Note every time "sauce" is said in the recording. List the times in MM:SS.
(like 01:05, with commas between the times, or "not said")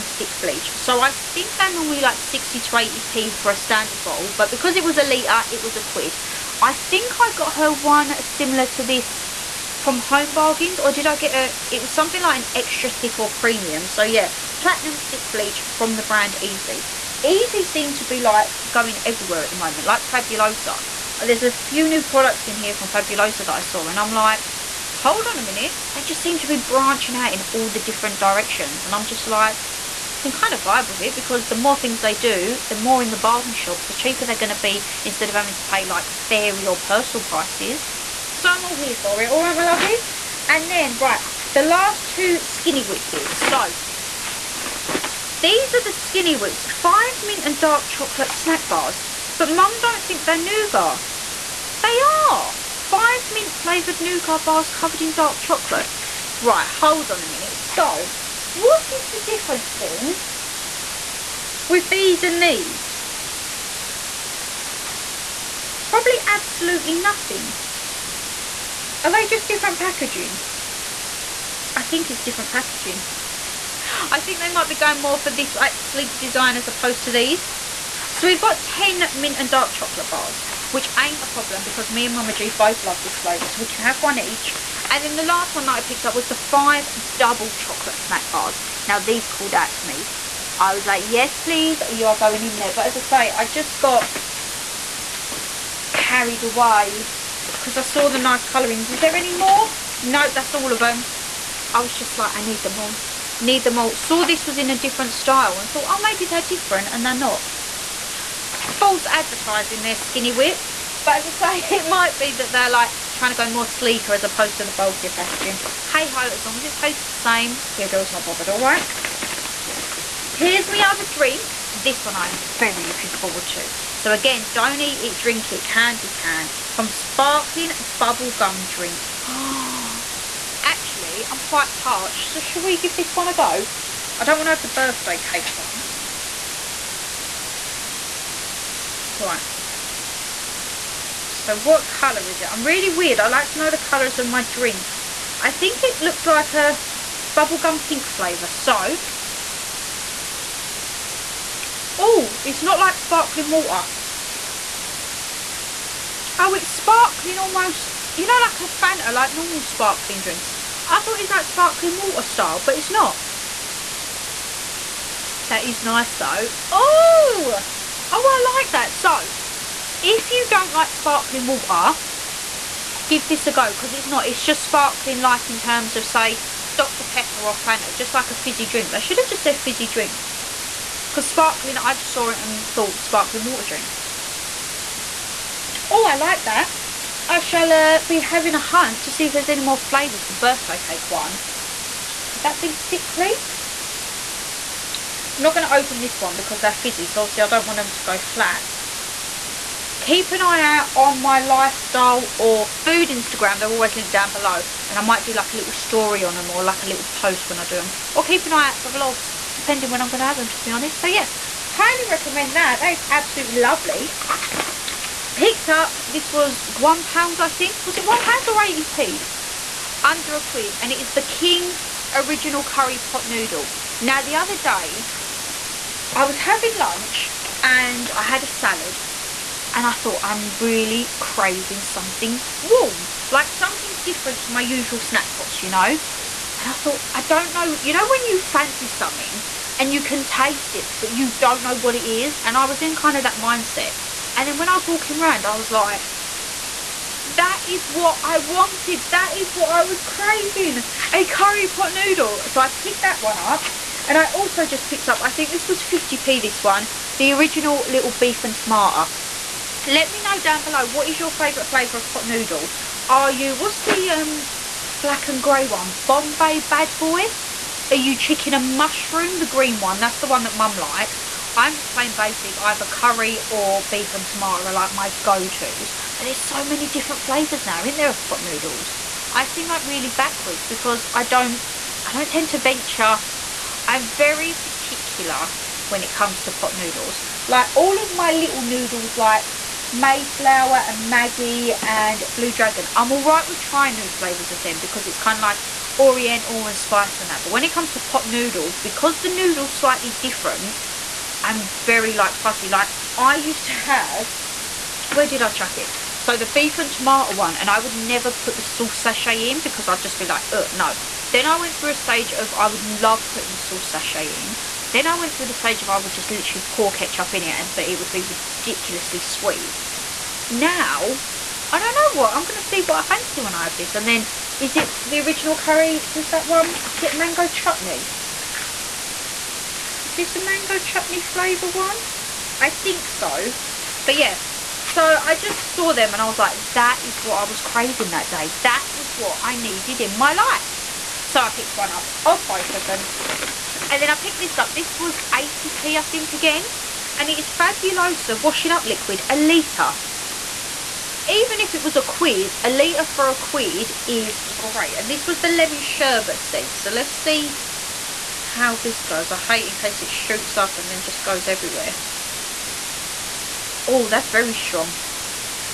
05:08, 05:13.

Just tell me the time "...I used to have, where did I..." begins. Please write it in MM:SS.
05:03.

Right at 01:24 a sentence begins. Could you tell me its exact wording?
And then the last one that I picked up was the five double chocolate snack bars.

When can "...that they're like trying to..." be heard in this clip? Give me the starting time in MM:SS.
01:52.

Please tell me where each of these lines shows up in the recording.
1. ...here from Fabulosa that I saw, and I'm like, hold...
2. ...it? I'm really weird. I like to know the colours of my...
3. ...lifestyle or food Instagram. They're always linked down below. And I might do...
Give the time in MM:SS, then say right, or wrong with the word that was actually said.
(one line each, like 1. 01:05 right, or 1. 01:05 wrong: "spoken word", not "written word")
1. 00:22 right
2. 02:22 right
3. 03:21 right.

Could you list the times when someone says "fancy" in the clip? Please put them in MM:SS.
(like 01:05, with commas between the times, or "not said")
03:58, 05:23.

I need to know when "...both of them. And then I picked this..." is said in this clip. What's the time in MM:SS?
05:42.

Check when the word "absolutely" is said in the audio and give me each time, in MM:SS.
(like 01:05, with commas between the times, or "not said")
01:06, 03:33.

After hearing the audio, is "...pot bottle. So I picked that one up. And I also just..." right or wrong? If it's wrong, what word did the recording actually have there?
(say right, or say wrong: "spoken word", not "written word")
wrong: "noodle", not "bottle".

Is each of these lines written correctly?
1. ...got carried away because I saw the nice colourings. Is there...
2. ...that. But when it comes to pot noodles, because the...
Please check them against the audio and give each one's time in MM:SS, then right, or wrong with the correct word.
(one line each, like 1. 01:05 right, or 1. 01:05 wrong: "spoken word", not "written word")
1. 01:33 right
2. 04:57 right.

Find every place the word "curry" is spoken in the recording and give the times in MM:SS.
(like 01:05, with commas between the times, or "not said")
03:42, 04:11, 04:32, 05:25.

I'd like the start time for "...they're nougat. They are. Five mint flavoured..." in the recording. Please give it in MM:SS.
00:50.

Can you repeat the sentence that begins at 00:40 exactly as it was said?
And then, right, the last two skinny whip bits.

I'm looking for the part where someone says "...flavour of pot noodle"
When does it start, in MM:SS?
04:21.